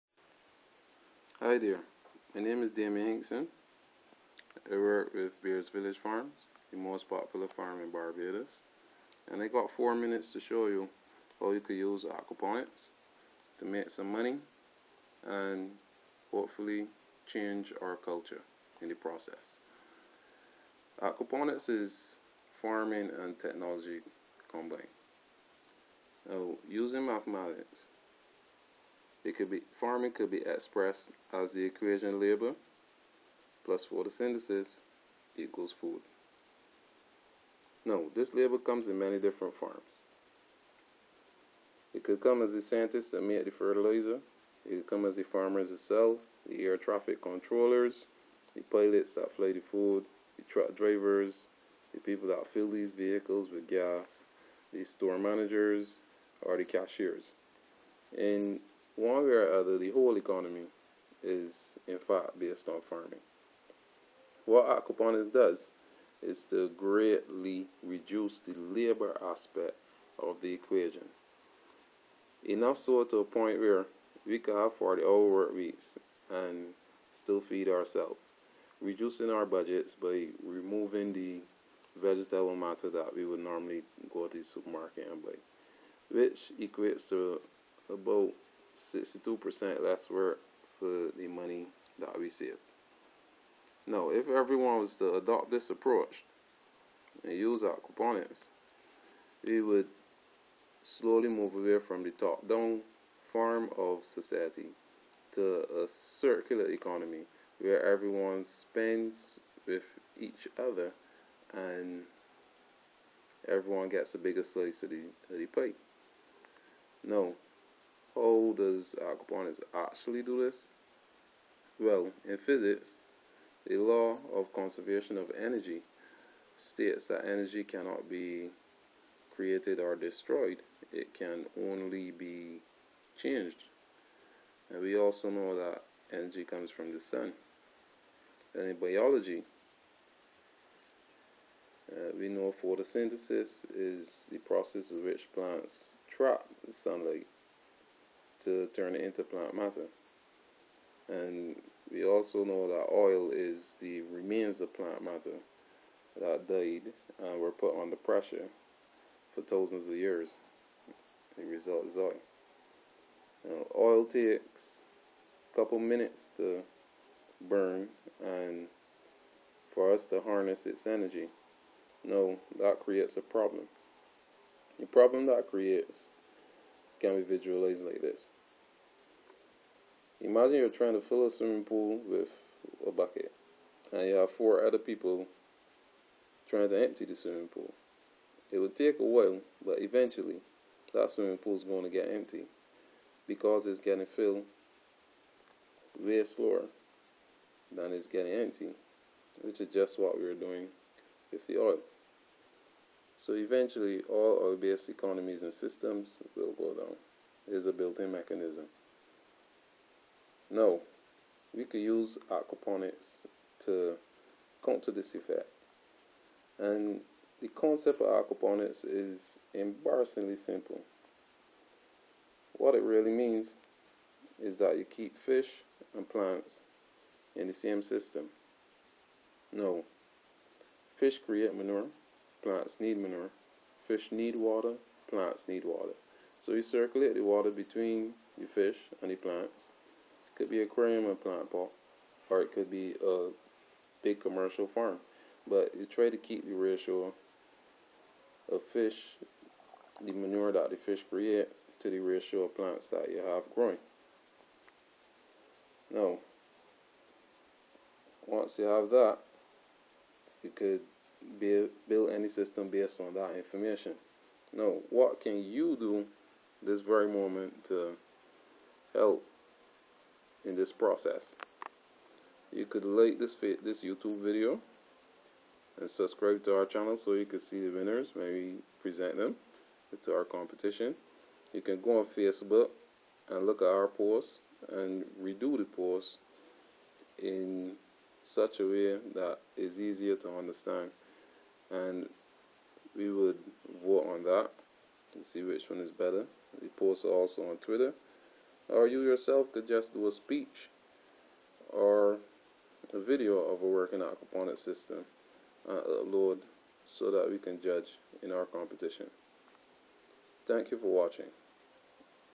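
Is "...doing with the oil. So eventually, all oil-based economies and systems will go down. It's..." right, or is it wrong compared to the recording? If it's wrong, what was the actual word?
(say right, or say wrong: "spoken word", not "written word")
right.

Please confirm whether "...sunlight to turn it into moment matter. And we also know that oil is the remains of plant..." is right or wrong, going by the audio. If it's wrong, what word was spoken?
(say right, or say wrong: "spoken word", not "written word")
wrong: "plant", not "moment".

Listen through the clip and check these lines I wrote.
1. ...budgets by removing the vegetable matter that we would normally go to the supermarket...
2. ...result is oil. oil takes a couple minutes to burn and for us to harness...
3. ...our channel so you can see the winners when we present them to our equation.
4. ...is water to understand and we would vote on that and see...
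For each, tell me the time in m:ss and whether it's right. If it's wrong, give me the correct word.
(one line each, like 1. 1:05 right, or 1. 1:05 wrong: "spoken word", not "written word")
1. 1:19 right
2. 2:41 right
3. 4:36 wrong: "competition", not "equation"
4. 4:49 wrong: "easier", not "water".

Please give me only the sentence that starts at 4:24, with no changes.
Now, what can you do this very moment to help in this process.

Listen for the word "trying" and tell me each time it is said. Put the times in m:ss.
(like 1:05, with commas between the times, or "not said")
3:00, 3:06.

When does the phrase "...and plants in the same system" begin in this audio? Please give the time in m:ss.
3:45.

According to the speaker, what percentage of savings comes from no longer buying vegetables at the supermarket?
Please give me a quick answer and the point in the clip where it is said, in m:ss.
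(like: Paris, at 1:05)
62%, at 1:29.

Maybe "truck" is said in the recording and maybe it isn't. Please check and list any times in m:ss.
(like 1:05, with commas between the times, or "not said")
0:50.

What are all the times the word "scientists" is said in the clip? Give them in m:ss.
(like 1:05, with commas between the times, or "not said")
0:42.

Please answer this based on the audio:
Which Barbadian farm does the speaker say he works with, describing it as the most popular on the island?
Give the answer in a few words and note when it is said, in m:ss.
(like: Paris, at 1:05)
Bears Village Farms, at 0:05.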